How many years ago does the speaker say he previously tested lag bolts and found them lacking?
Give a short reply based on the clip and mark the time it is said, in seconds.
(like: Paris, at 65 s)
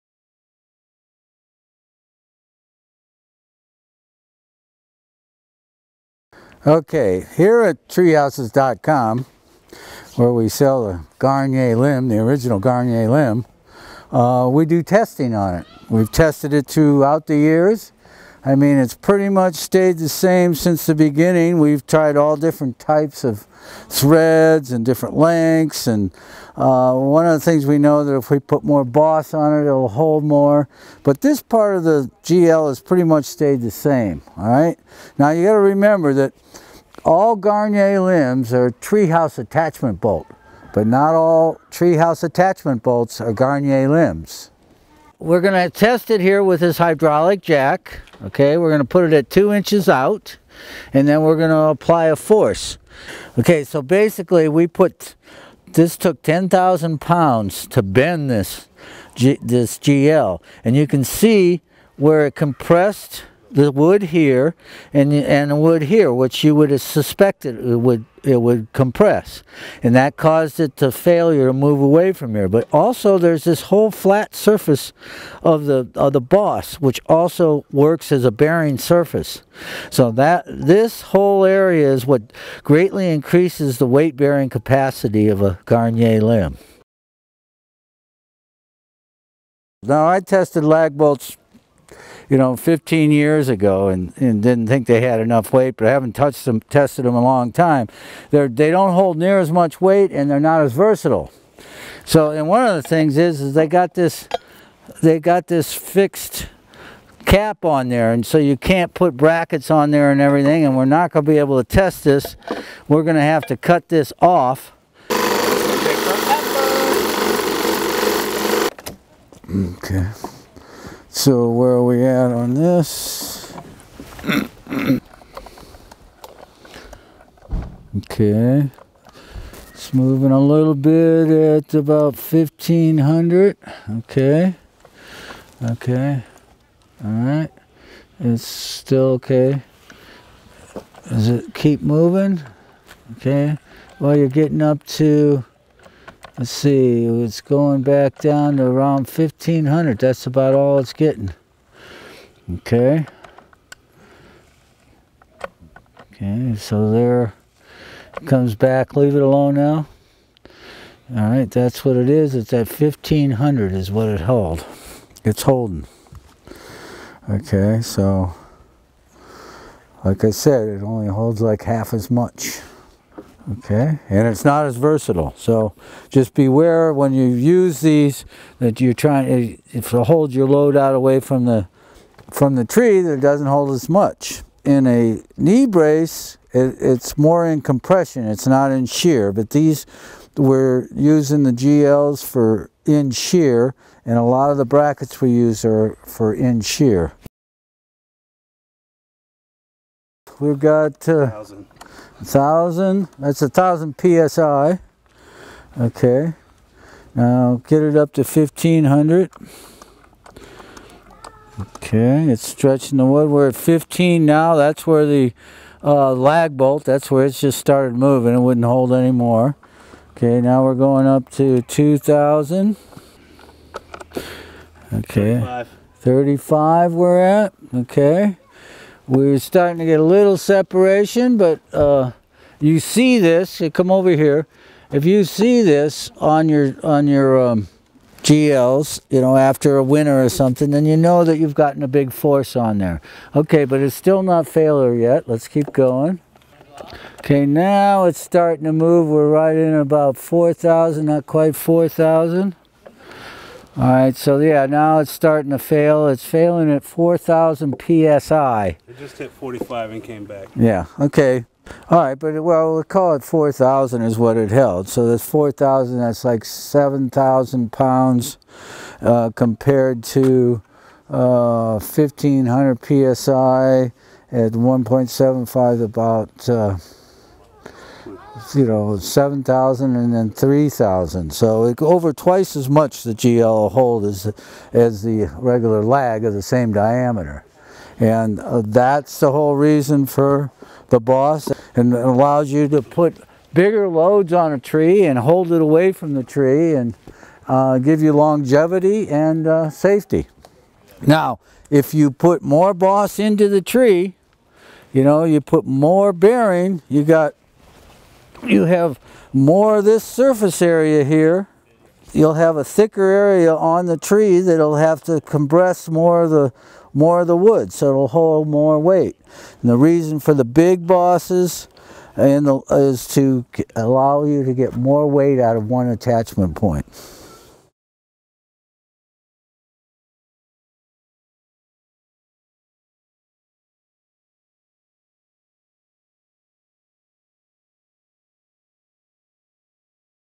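15, at 92 s.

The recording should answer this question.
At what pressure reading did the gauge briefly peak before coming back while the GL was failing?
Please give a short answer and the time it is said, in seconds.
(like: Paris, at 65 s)
45, at 259 s.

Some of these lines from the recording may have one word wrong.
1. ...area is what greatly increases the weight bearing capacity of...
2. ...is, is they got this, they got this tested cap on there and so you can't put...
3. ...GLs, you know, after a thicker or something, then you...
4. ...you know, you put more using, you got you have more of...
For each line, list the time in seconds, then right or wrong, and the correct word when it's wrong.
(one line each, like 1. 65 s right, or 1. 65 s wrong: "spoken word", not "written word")
1. 81 s right
2. 103 s wrong: "fixed", not "tested"
3. 238 s wrong: "winter", not "thicker"
4. 304 s wrong: "bearing", not "using".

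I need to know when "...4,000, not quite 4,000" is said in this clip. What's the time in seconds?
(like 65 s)
250 s.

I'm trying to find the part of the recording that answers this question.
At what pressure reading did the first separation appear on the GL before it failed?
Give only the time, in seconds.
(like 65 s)
225 s.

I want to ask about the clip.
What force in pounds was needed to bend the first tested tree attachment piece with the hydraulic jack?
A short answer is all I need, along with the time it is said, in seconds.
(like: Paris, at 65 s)
10,000 pounds, at 56 s.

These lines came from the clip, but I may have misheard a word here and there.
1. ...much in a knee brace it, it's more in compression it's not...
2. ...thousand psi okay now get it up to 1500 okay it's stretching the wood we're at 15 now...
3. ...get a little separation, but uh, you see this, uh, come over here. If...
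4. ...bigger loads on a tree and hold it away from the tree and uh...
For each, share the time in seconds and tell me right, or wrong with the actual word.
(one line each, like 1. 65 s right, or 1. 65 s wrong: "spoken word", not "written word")
1. 183 s right
2. 203 s right
3. 229 s right
4. 293 s right.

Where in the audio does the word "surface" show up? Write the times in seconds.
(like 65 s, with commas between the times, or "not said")
74 s, 78 s, 310 s.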